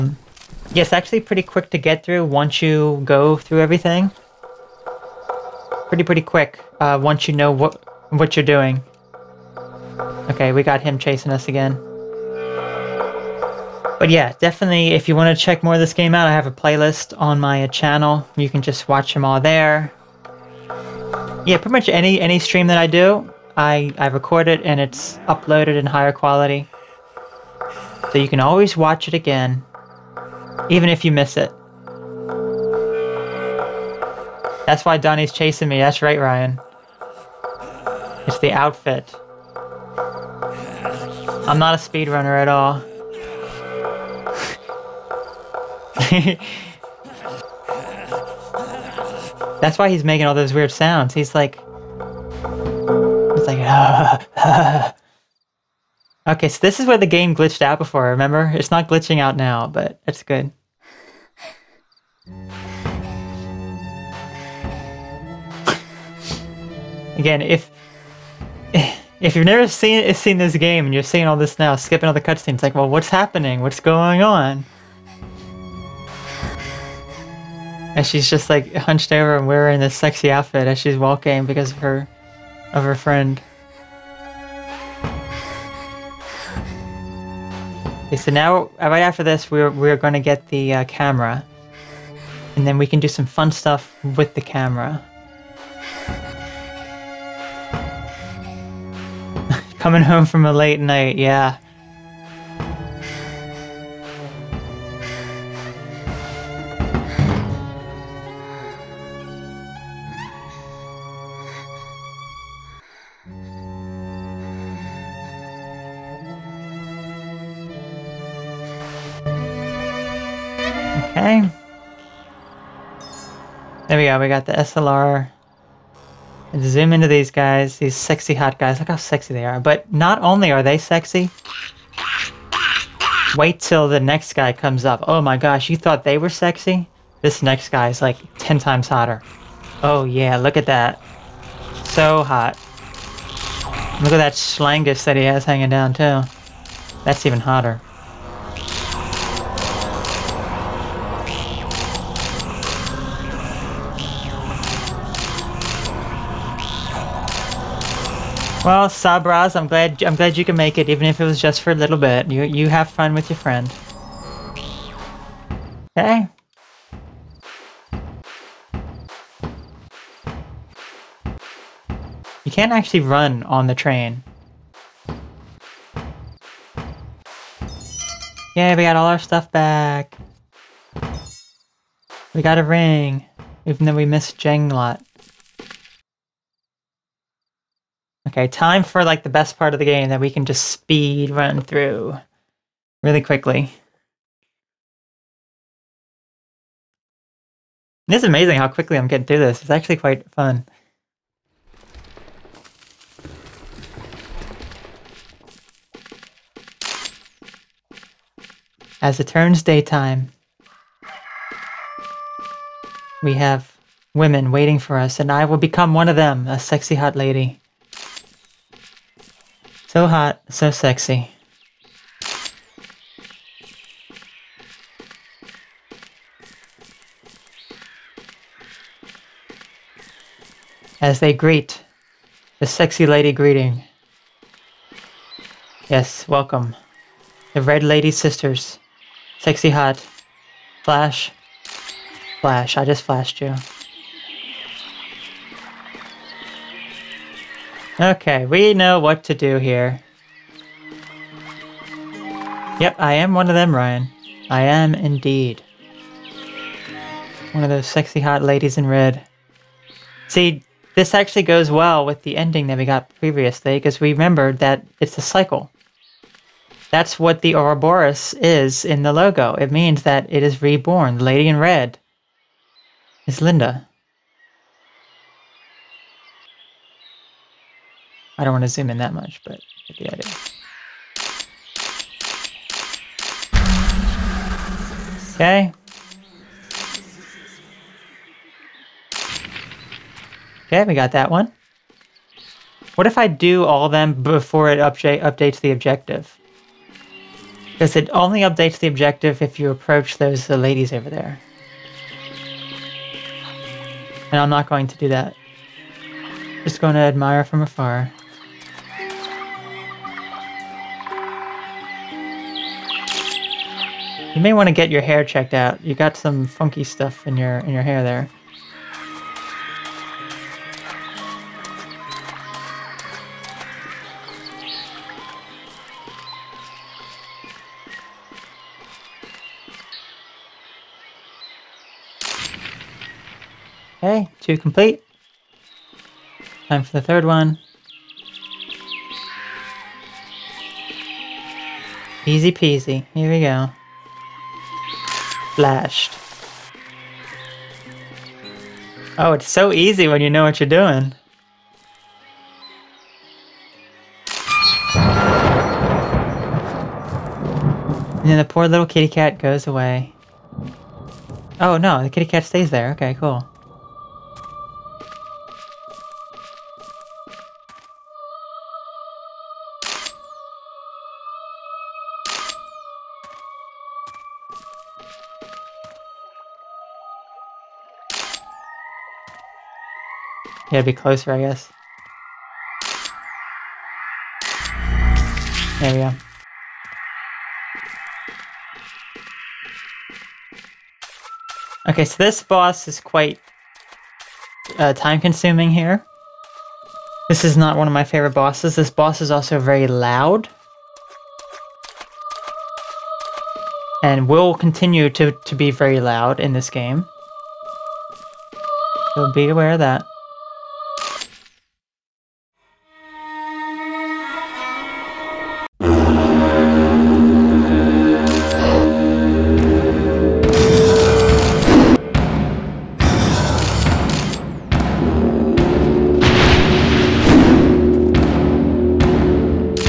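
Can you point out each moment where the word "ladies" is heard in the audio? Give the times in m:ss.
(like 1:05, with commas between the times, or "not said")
4:18, 5:00.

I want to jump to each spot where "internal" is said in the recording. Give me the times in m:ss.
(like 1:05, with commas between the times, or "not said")
not said.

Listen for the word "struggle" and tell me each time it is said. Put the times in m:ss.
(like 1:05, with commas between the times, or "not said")
not said.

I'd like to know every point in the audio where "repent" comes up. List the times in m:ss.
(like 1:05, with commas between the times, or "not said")
not said.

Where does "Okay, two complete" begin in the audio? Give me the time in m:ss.
5:34.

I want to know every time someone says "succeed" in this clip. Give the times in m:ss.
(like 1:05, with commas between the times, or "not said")
not said.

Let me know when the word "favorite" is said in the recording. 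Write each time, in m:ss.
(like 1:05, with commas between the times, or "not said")
6:38.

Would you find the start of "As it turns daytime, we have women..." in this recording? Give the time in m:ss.
3:29.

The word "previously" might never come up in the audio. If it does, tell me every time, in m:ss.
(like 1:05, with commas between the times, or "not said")
4:23.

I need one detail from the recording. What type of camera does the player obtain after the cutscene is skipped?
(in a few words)
SLR.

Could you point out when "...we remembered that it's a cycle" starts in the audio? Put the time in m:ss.
4:23.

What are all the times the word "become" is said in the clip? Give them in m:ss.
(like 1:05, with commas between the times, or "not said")
3:35.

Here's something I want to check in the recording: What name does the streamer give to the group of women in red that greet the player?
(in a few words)
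The Red Lady Sisters.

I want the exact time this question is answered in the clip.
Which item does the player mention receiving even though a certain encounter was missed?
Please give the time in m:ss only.
3:02.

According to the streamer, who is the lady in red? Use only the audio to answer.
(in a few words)
Linda.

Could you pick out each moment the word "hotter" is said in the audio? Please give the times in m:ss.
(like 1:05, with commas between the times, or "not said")
2:18, 2:27.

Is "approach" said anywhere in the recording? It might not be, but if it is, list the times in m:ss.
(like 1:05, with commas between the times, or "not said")
4:59.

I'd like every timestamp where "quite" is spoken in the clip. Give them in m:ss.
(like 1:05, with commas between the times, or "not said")
3:19, 6:33.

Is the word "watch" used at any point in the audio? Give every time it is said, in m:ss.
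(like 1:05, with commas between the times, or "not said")
0:18, 0:28.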